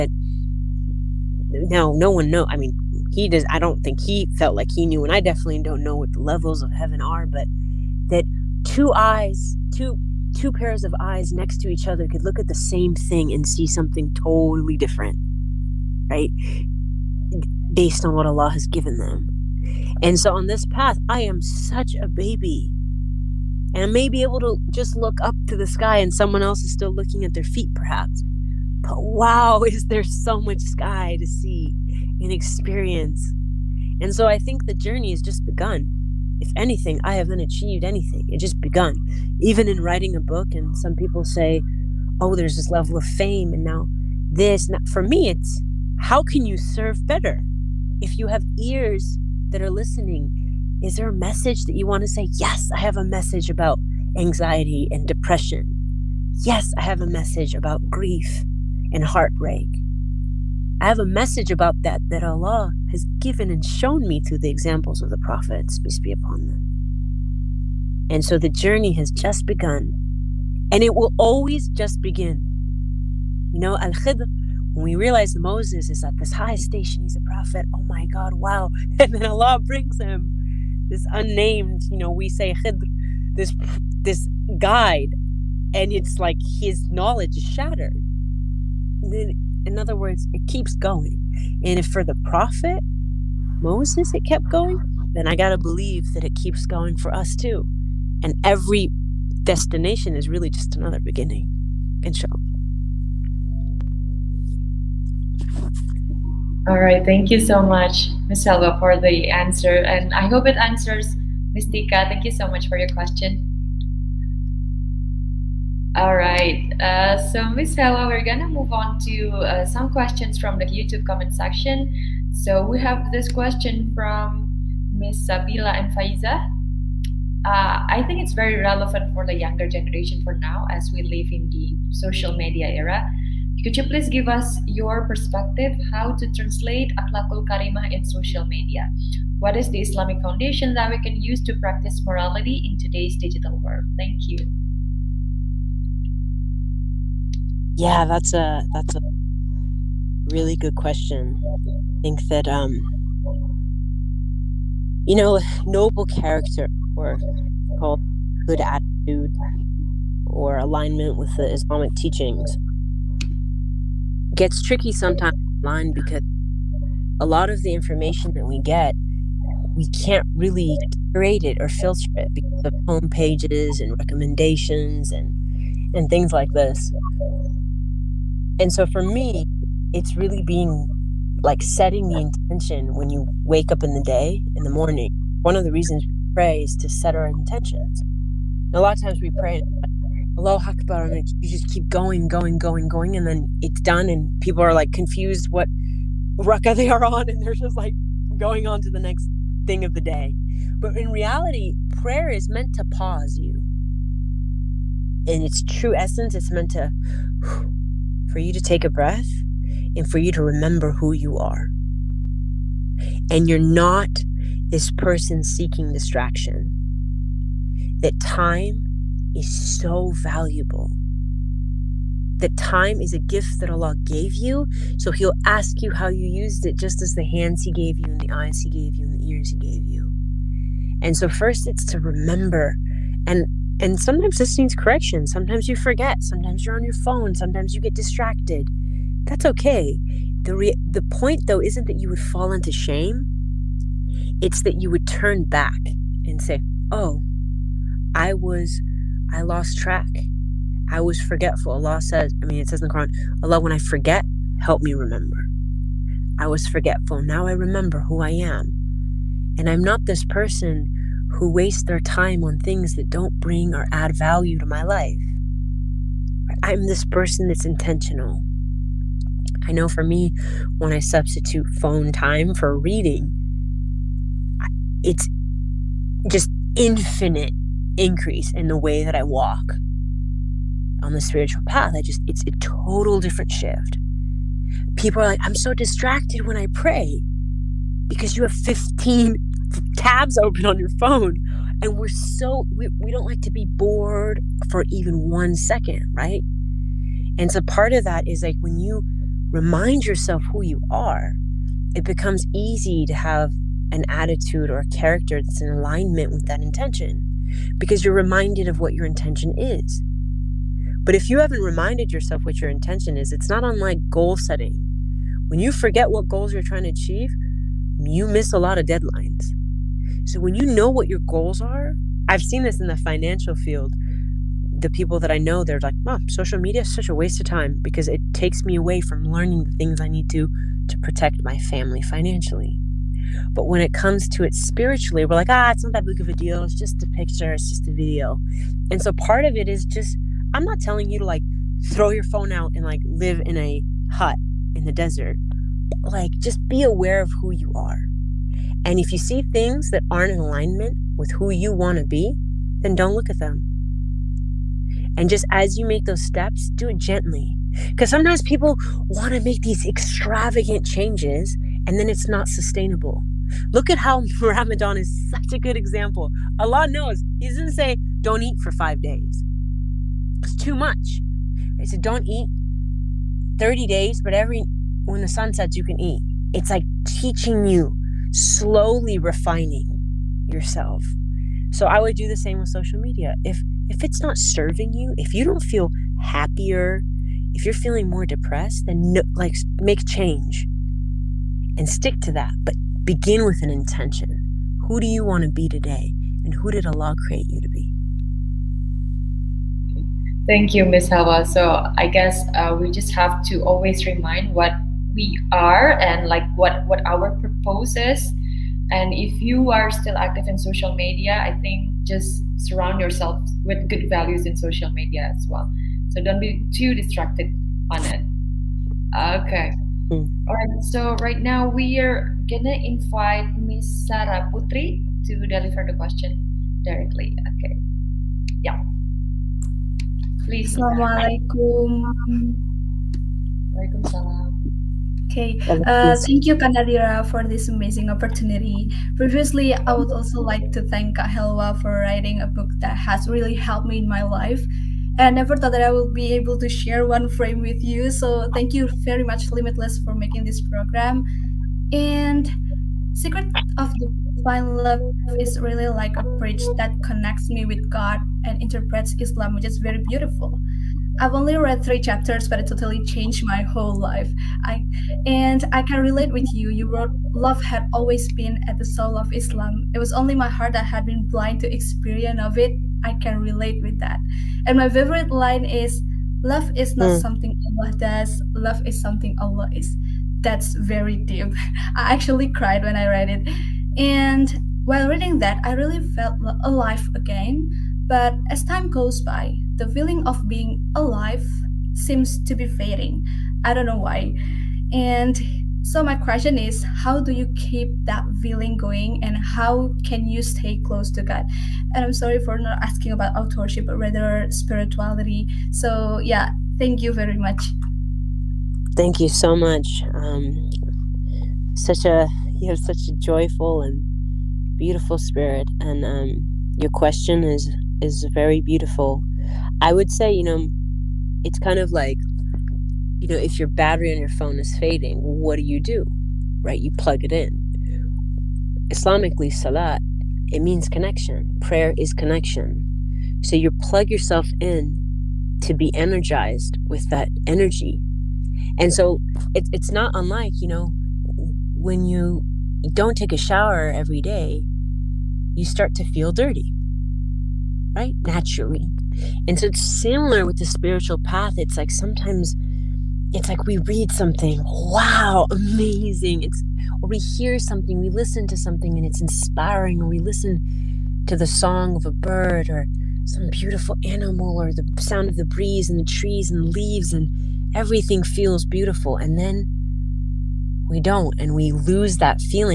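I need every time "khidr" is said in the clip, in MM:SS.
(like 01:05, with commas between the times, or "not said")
01:13, 01:22.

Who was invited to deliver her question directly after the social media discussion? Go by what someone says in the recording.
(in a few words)
Sarah Putri.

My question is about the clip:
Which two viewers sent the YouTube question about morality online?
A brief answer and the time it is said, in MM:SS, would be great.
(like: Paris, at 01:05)
Sabila and Faiza, at 02:05.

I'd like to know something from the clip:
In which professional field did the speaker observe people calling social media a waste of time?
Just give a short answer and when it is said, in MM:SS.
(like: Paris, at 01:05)
financial field, at 05:22.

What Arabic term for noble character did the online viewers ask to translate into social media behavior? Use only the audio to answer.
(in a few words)
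akhlakul karimah.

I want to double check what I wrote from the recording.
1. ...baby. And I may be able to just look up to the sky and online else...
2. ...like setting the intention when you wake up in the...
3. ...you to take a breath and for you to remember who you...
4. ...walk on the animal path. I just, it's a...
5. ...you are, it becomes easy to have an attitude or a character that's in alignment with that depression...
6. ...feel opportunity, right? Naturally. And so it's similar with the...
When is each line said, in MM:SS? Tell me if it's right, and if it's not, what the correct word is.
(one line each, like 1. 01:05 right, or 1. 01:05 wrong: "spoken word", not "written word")
1. 00:22 wrong: "someone", not "online"
2. 03:01 right
3. 03:28 right
4. 04:39 wrong: "spiritual", not "animal"
5. 05:00 wrong: "intention", not "depression"
6. 09:06 wrong: "dirty", not "opportunity".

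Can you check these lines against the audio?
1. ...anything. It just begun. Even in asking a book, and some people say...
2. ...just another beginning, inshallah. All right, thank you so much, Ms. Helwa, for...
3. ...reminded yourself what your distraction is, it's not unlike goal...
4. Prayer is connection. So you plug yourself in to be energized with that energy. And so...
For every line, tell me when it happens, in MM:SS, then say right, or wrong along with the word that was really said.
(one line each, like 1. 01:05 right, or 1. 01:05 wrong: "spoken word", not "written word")
1. 00:37 wrong: "writing", not "asking"
2. 01:40 right
3. 05:11 wrong: "intention", not "distraction"
4. 08:51 right.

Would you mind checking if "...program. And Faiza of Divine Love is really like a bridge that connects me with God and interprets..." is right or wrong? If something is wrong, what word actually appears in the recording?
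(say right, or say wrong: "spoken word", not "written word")
wrong: "Secret", not "Faiza".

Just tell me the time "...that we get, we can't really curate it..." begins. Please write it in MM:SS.
02:48.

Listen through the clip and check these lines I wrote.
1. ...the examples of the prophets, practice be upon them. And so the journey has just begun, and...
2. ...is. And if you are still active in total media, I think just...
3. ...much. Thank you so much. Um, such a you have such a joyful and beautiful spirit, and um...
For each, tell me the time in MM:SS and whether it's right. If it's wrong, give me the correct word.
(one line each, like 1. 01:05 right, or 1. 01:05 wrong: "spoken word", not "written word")
1. 01:04 wrong: "peace", not "practice"
2. 06:47 wrong: "social", not "total"
3. 08:27 right.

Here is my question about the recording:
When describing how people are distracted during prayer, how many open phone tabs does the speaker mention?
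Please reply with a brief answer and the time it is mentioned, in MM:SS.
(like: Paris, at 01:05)
15, at 04:48.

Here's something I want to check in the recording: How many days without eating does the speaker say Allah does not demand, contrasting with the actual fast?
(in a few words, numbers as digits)
5.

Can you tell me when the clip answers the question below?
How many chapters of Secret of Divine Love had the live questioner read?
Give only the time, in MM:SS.
07:41.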